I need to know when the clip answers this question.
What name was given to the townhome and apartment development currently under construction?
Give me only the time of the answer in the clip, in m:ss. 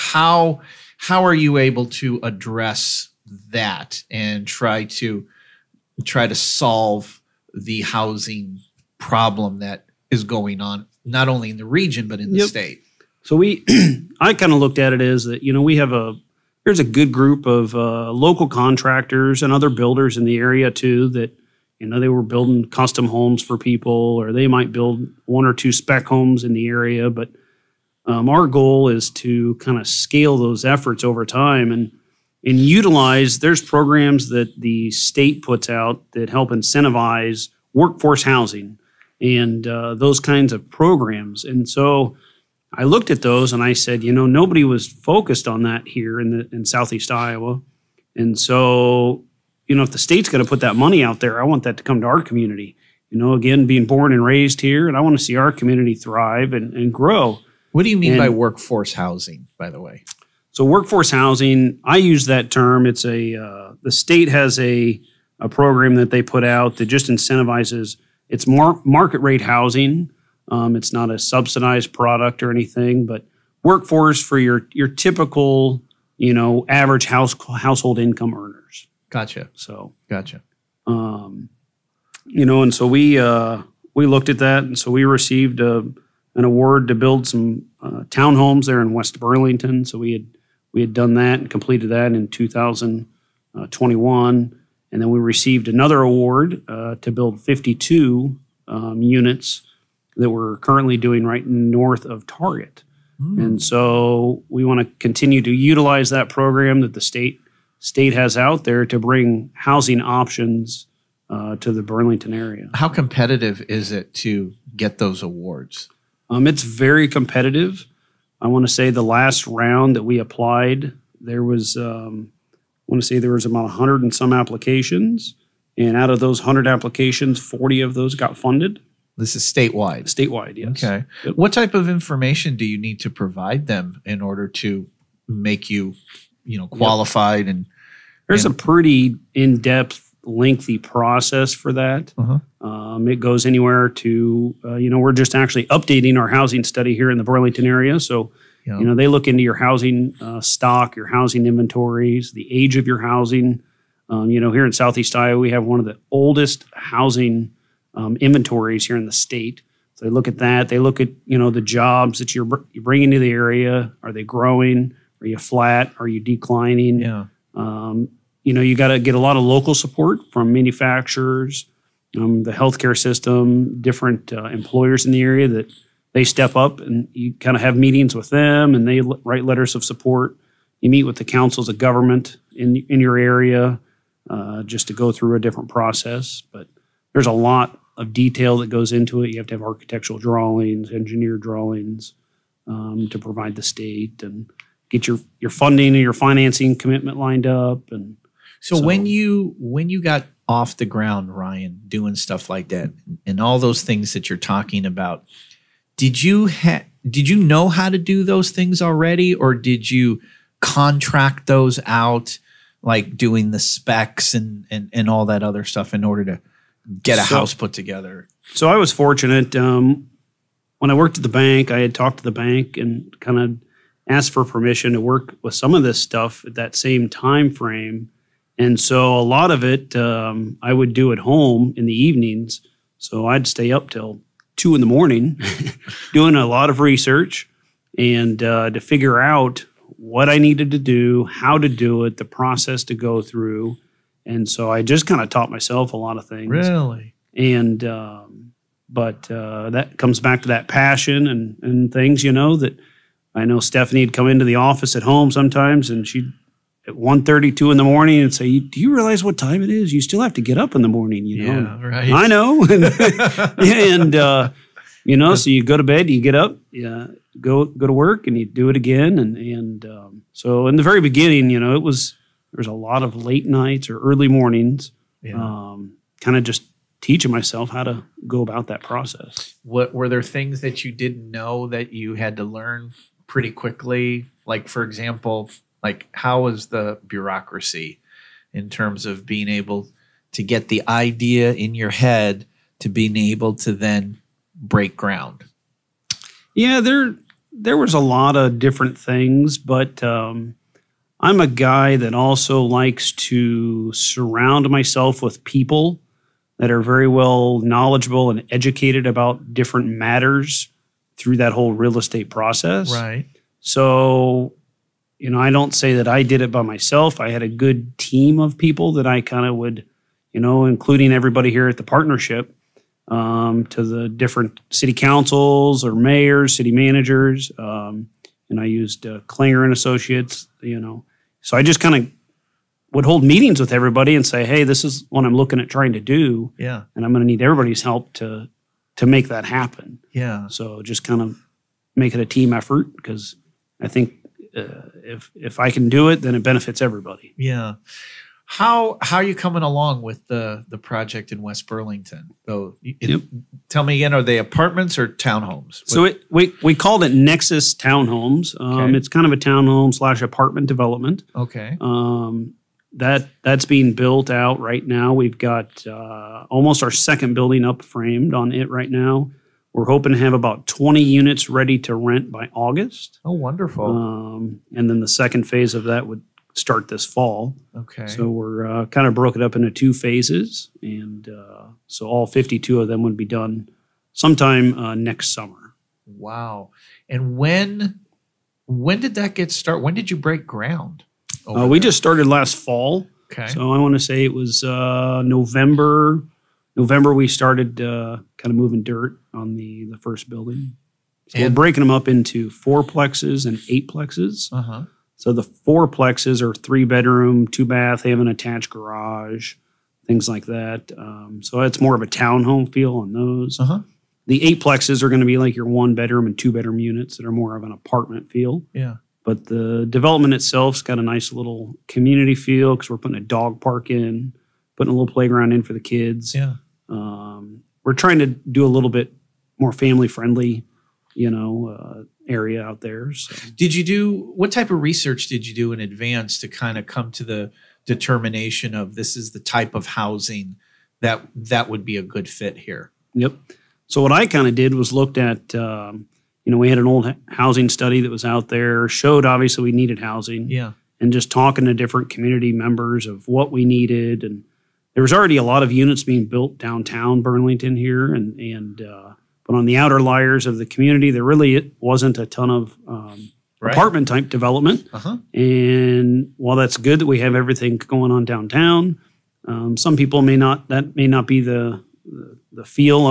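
5:57.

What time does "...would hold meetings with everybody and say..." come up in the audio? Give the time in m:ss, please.
5:32.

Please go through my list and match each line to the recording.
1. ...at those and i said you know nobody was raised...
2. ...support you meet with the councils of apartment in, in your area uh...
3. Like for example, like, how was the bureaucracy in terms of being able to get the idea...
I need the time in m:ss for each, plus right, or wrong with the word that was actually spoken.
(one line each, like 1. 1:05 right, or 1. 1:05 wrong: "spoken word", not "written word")
1. 0:43 wrong: "focused", not "raised"
2. 2:59 wrong: "government", not "apartment"
3. 4:44 right.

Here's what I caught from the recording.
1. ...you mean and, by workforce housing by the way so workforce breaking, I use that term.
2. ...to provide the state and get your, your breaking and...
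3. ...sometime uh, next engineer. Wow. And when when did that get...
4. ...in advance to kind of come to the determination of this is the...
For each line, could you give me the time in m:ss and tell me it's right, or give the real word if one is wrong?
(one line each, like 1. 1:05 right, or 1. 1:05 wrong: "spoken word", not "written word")
1. 0:57 wrong: "housing", not "breaking"
2. 3:13 wrong: "funding", not "breaking"
3. 6:24 wrong: "summer", not "engineer"
4. 7:15 right.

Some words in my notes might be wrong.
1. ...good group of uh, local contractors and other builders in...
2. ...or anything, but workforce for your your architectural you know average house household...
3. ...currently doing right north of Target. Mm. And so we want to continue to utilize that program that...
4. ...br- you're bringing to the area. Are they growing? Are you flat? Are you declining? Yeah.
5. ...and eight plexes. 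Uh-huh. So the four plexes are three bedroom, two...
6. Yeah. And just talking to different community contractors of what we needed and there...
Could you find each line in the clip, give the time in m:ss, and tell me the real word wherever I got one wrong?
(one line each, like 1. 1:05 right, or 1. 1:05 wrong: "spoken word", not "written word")
1. 0:16 right
2. 1:12 wrong: "typical", not "architectural"
3. 1:40 right
4. 2:42 right
5. 6:43 right
6. 7:30 wrong: "members", not "contractors".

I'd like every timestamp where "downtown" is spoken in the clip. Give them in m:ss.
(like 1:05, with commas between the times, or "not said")
7:36, 7:48.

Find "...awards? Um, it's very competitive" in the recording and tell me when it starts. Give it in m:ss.
1:55.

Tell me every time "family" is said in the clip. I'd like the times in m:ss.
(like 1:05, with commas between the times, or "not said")
7:09.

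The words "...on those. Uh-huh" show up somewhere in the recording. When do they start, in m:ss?
6:52.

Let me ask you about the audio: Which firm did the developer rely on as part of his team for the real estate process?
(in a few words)
Klingner and Associates.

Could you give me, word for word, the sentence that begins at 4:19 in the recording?
You still have to get up in the morning, you know?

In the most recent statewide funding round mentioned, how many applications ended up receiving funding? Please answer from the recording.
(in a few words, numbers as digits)
40.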